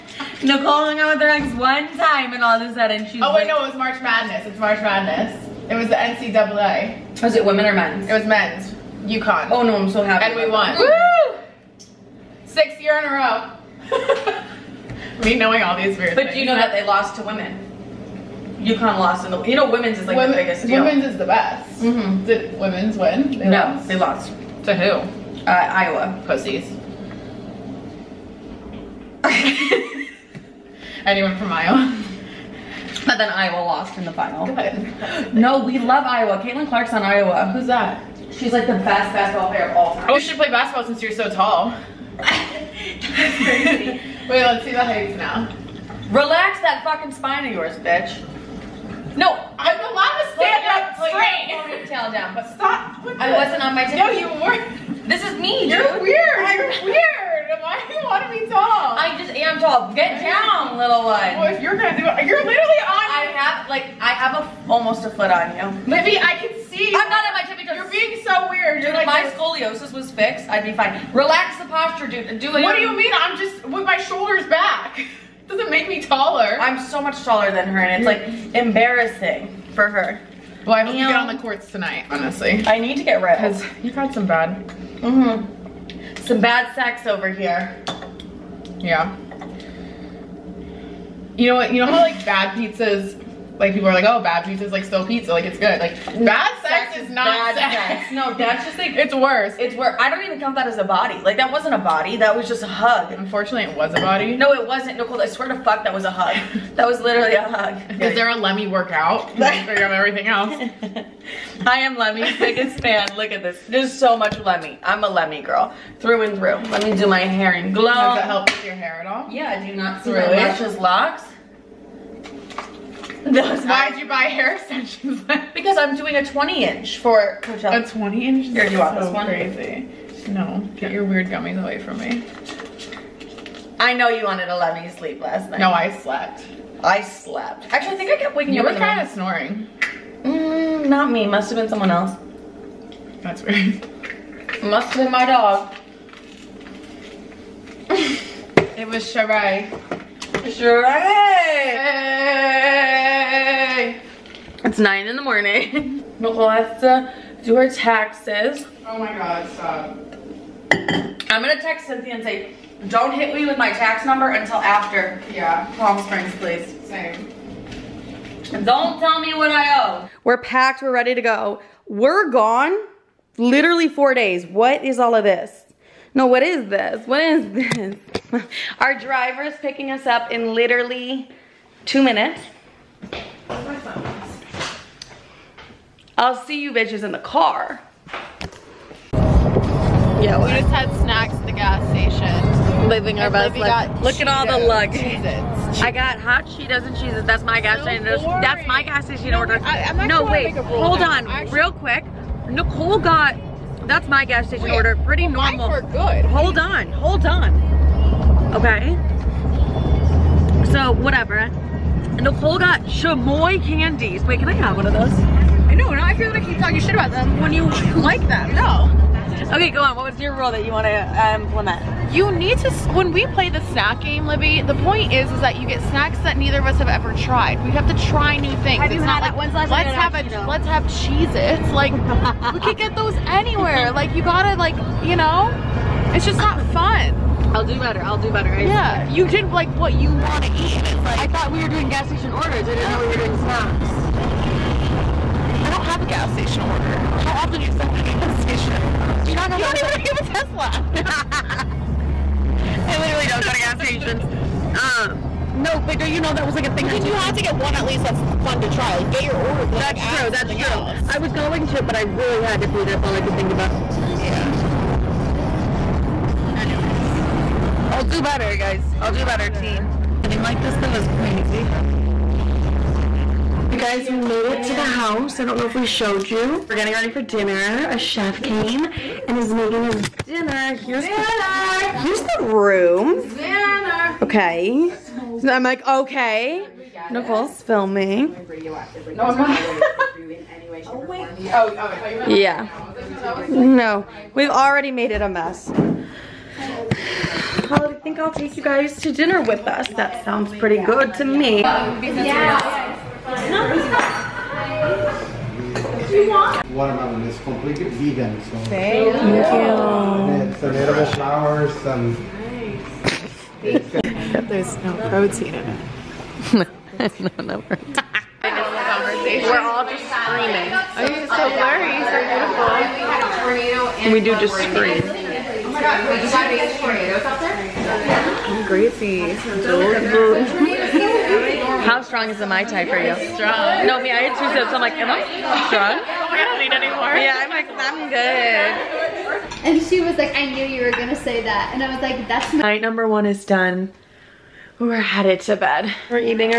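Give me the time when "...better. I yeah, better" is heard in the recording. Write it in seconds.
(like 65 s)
238 s.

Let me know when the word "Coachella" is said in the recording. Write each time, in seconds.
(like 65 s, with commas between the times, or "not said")
127 s.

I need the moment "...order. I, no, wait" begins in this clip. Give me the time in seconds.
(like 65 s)
199 s.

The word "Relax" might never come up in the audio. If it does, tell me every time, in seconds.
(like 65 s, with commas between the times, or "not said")
46 s, 71 s.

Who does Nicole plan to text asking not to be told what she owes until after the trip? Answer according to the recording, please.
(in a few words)
Cynthia.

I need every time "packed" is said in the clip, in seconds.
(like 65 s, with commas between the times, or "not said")
170 s.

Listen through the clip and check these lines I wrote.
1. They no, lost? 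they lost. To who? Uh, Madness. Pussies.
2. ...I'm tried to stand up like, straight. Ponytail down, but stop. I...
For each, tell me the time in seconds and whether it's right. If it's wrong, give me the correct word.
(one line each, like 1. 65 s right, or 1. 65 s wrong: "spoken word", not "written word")
1. 23 s wrong: "Iowa", not "Madness"
2. 49 s wrong: "allowed", not "tried".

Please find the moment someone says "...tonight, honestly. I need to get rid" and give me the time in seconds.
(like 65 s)
81 s.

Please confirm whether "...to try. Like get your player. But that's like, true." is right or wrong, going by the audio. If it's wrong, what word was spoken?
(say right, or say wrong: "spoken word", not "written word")
wrong: "order", not "player".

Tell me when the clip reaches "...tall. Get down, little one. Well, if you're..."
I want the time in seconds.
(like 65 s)
59 s.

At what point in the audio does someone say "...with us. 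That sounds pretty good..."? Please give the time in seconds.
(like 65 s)
299 s.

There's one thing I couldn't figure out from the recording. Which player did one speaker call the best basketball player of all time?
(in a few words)
Caitlin Clark.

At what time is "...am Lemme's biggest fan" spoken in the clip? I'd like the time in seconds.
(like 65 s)
111 s.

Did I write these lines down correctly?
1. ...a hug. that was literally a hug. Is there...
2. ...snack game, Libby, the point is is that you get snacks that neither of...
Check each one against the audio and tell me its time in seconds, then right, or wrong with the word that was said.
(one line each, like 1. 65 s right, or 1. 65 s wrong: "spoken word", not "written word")
1. 106 s right
2. 223 s right.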